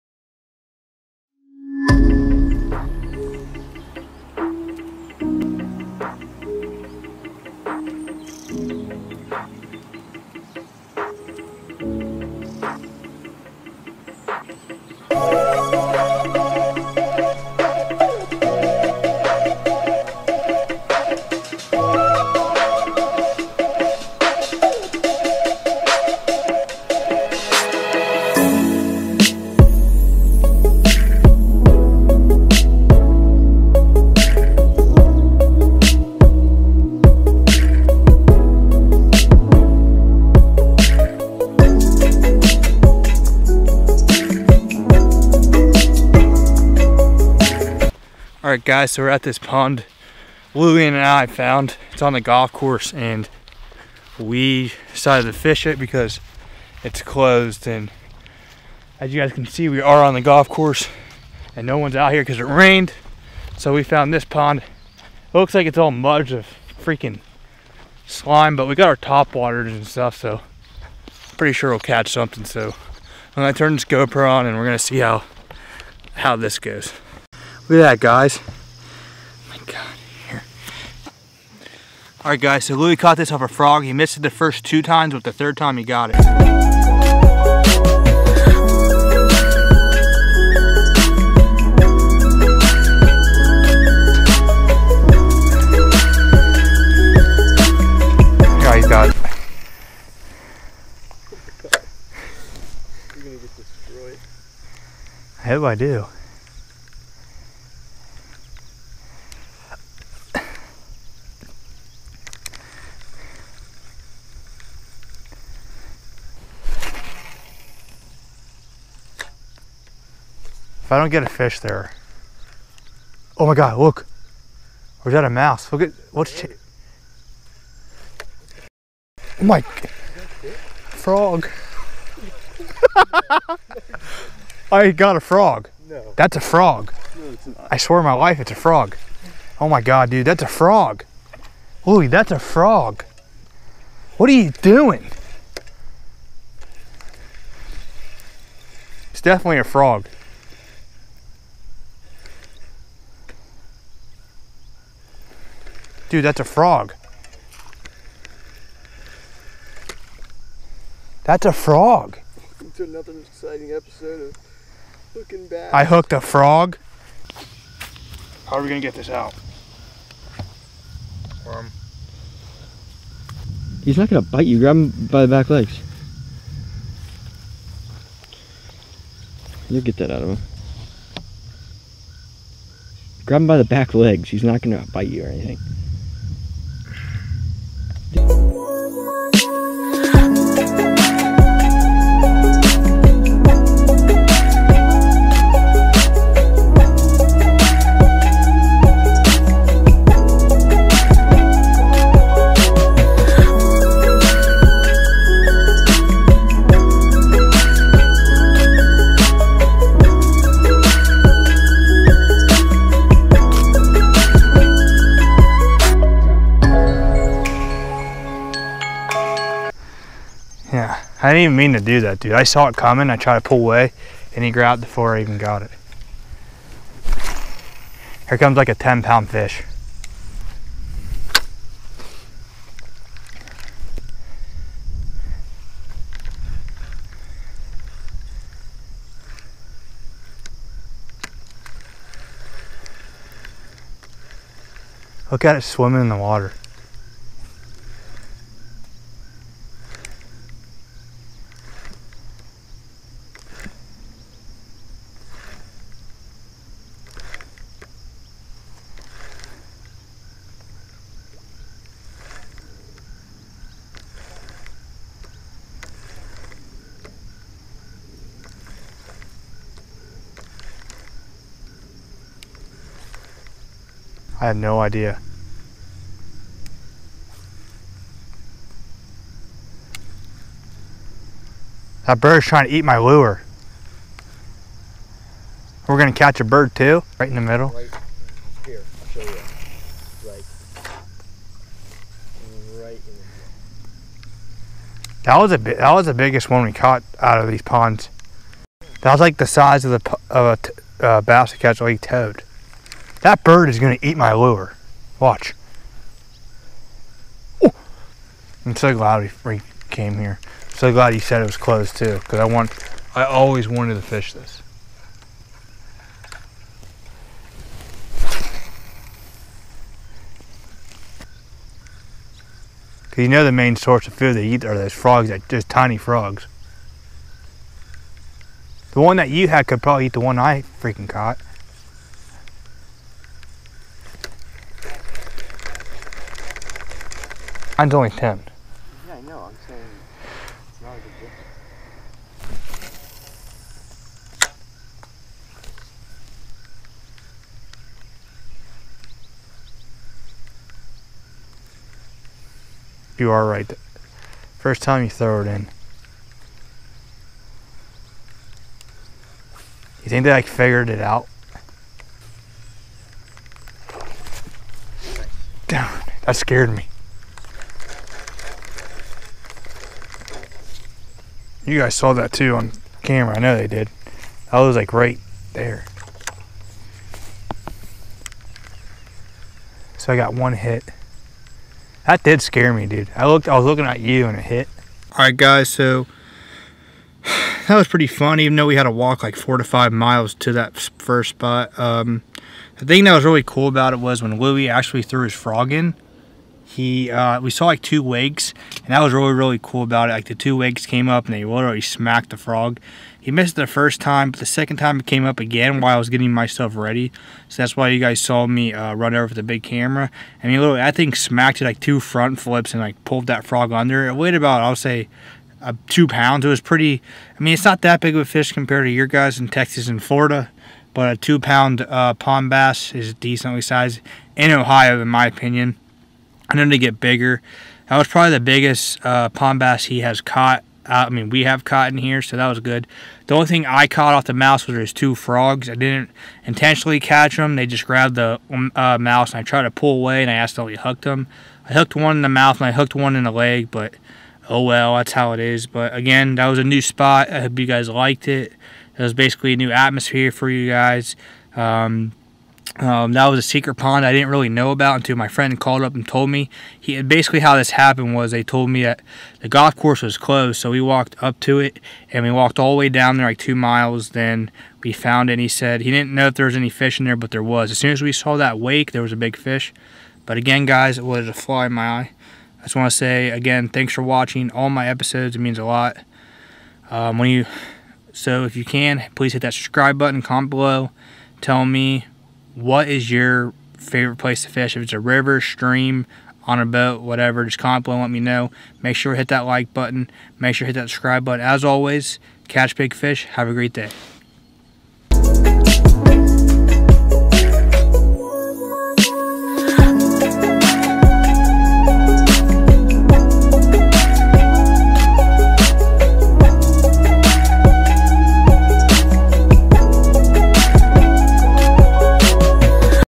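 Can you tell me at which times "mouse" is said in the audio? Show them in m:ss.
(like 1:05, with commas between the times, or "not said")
2:05, 7:14, 7:18.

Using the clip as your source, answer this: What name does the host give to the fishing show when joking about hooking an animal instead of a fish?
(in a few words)
Hooknbass.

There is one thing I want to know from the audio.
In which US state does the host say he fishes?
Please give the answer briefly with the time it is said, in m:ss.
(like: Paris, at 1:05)
Ohio, at 7:04.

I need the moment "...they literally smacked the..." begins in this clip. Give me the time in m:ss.
6:41.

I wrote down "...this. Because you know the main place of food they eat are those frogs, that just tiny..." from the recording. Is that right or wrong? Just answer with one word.
wrong.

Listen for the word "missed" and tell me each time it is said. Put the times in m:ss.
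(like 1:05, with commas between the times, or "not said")
1:23, 6:43.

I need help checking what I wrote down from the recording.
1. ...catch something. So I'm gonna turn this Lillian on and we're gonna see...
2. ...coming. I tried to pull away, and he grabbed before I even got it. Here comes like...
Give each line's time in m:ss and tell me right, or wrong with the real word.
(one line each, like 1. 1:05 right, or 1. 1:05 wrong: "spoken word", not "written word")
1. 1:11 wrong: "GoPro", not "Lillian"
2. 3:42 right.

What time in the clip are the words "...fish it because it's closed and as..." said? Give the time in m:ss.
0:55.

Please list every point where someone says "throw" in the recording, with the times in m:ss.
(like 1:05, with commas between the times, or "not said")
5:55.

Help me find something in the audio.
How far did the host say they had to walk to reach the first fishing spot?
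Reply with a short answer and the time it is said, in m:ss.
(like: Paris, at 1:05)
4 to 5 miles, at 6:29.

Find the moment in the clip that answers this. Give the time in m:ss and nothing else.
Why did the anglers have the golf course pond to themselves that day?
1:02.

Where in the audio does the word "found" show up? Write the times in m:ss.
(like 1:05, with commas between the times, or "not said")
0:51, 1:03, 7:44.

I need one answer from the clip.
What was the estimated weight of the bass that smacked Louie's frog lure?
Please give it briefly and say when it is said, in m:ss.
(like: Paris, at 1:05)
2 pounds, at 6:55.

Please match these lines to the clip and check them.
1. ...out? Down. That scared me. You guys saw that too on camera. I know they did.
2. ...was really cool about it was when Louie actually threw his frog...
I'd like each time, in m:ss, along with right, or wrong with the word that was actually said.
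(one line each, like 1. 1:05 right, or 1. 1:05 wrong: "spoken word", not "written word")
1. 6:01 right
2. 6:33 right.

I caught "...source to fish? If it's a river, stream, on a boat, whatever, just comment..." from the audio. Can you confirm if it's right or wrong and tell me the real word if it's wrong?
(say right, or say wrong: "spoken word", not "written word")
wrong: "place", not "source".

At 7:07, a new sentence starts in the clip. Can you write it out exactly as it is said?
That was probably the biggest uh, pond bass he has caught.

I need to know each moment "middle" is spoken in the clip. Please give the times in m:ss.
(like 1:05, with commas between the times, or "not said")
4:47, 4:52.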